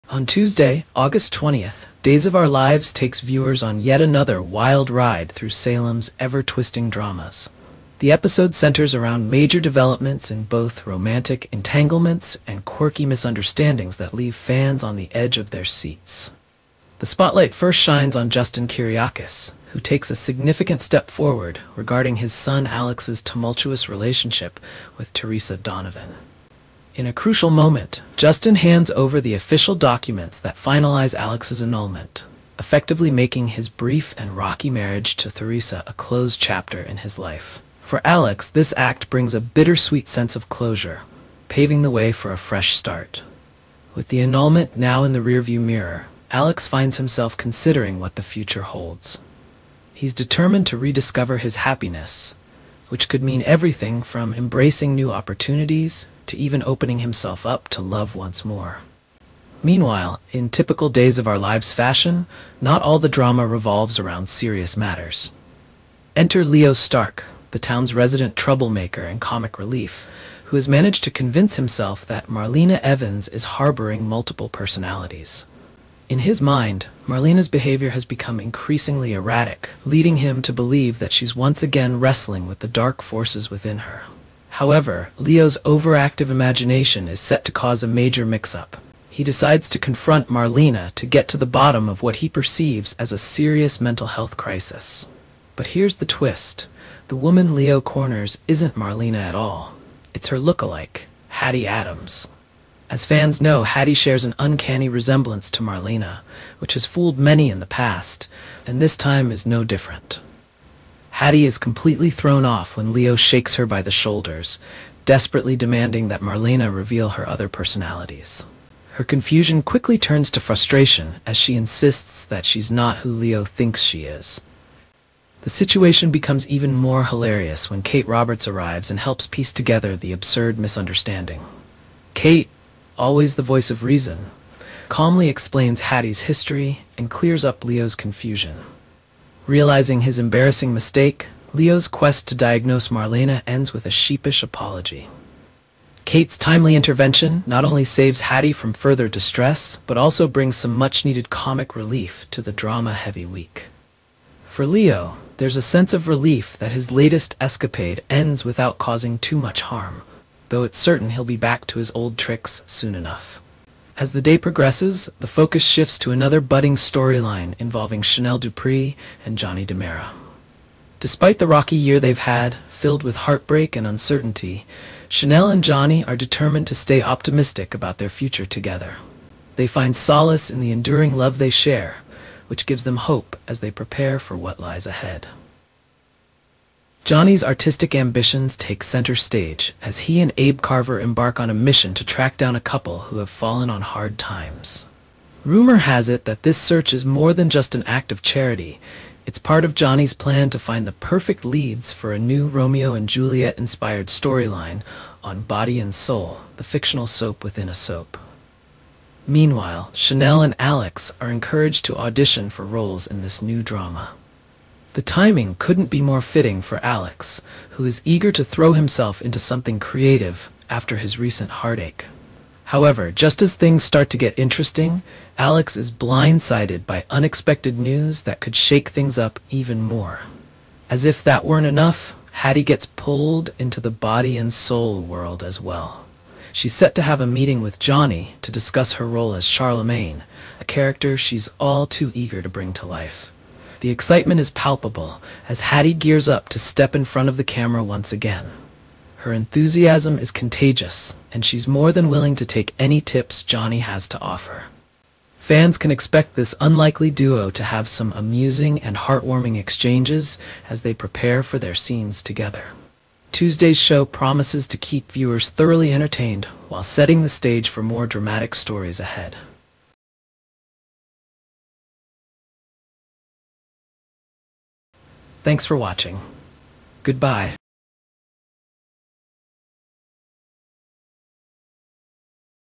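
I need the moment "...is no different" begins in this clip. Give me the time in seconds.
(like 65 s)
109 s.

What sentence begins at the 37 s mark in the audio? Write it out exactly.
For Alex, this act brings a bittersweet sense of closure, paving the way for a fresh start.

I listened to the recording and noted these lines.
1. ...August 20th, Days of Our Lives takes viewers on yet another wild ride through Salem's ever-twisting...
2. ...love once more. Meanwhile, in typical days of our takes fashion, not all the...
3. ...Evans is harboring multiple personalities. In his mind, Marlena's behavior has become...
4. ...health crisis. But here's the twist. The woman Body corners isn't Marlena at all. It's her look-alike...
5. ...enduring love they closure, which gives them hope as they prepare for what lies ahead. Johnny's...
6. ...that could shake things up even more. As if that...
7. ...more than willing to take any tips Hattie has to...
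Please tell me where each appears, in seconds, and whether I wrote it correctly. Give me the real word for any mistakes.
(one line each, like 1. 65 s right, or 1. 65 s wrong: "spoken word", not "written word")
1. 0 s right
2. 57 s wrong: "lives", not "takes"
3. 72 s right
4. 94 s wrong: "Leo", not "Body"
5. 180 s wrong: "share", not "closure"
6. 228 s right
7. 251 s wrong: "Johnny", not "Hattie".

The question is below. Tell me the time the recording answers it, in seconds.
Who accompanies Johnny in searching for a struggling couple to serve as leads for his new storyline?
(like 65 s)
190 s.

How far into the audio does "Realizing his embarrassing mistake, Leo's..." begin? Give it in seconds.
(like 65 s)
139 s.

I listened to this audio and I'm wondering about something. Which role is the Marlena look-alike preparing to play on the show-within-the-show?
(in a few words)
Charlemagne.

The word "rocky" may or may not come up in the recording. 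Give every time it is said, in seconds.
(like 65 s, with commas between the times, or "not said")
34 s, 171 s.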